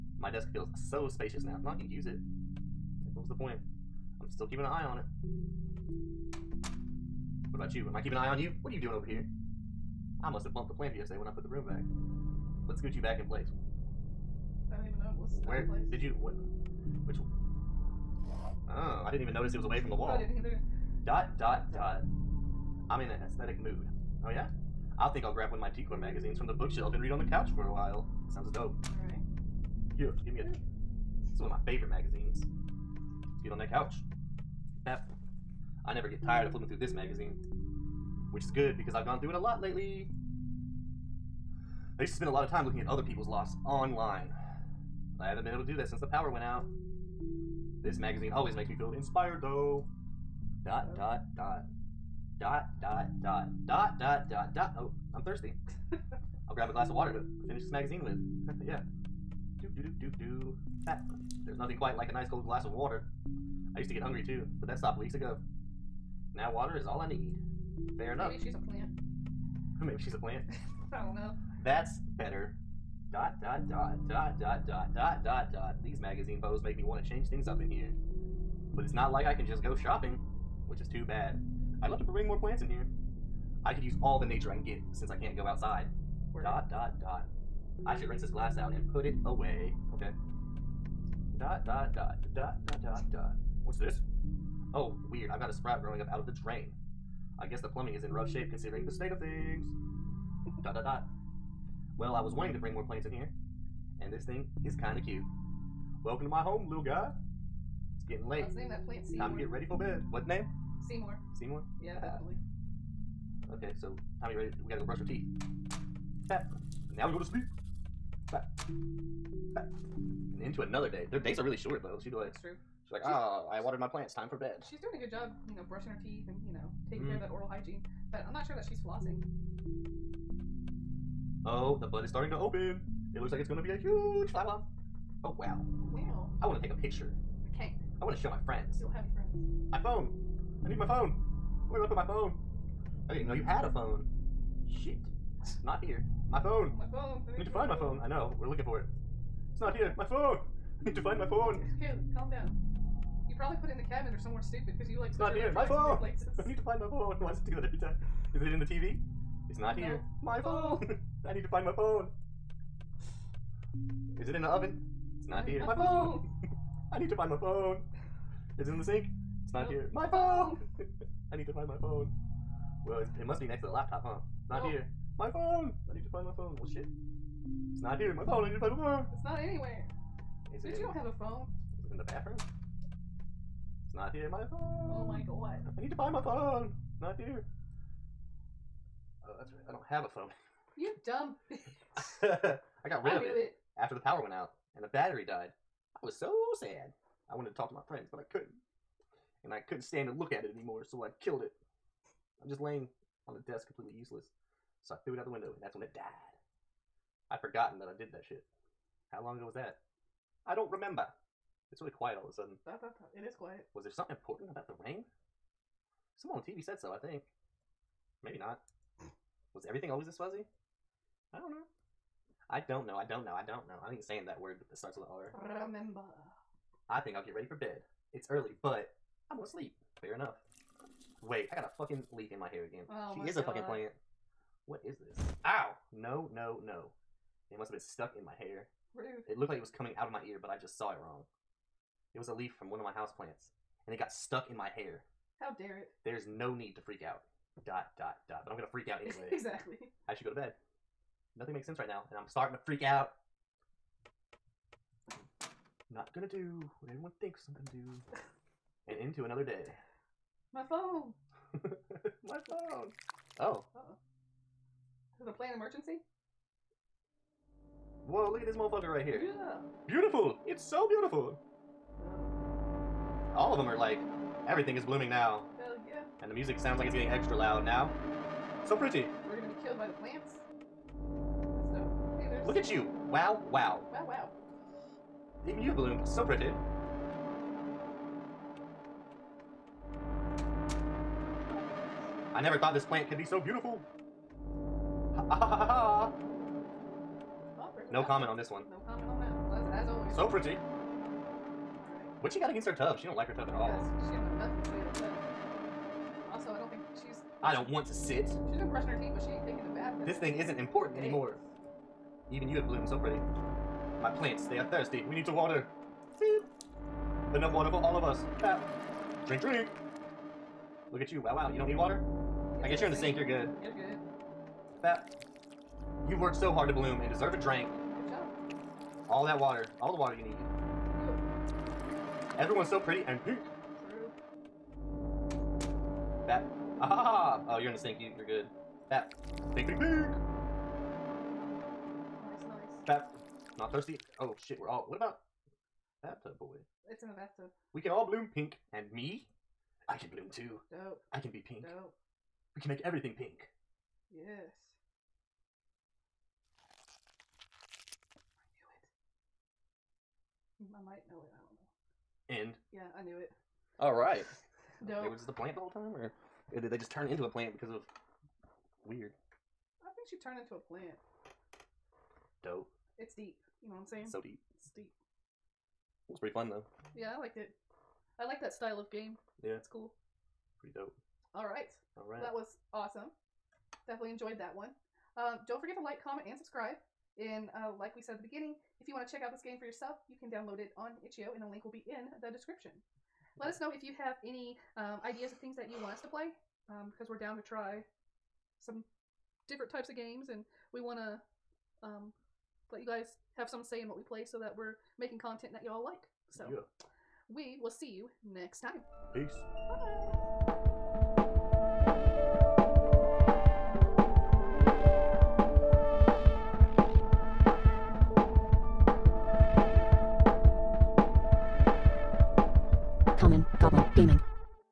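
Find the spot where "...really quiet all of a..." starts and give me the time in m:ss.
3:31.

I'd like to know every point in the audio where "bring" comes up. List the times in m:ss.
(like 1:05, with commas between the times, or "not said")
1:22, 1:42.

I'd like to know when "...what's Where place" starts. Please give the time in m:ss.
0:15.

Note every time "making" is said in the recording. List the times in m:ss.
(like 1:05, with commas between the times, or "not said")
6:44.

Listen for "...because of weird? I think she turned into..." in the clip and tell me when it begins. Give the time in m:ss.
6:07.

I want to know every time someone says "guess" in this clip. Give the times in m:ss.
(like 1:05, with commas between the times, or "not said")
1:37, 5:22.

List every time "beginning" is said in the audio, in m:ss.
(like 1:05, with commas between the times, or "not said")
6:28.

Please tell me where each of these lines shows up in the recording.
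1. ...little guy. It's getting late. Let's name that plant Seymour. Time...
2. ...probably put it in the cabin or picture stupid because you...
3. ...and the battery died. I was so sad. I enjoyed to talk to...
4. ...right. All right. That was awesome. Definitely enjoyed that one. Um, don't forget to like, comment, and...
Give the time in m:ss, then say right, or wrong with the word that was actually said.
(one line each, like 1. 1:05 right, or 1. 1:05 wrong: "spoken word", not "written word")
1. 1:46 right
2. 2:33 wrong: "somewhere", not "picture"
3. 3:14 wrong: "wanted", not "enjoyed"
4. 6:21 right.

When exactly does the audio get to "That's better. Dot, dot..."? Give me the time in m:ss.
1:11.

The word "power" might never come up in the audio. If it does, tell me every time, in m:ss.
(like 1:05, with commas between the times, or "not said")
0:46, 3:13.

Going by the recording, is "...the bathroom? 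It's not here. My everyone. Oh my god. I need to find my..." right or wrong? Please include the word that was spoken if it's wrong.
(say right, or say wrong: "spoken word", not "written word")
wrong: "phone", not "everyone".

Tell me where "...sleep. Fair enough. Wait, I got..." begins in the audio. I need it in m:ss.
3:49.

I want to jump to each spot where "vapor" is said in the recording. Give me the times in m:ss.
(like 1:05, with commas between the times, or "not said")
not said.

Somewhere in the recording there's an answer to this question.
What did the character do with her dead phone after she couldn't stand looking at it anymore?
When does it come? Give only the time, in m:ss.
3:25.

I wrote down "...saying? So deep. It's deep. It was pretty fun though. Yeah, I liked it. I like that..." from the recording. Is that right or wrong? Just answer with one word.
right.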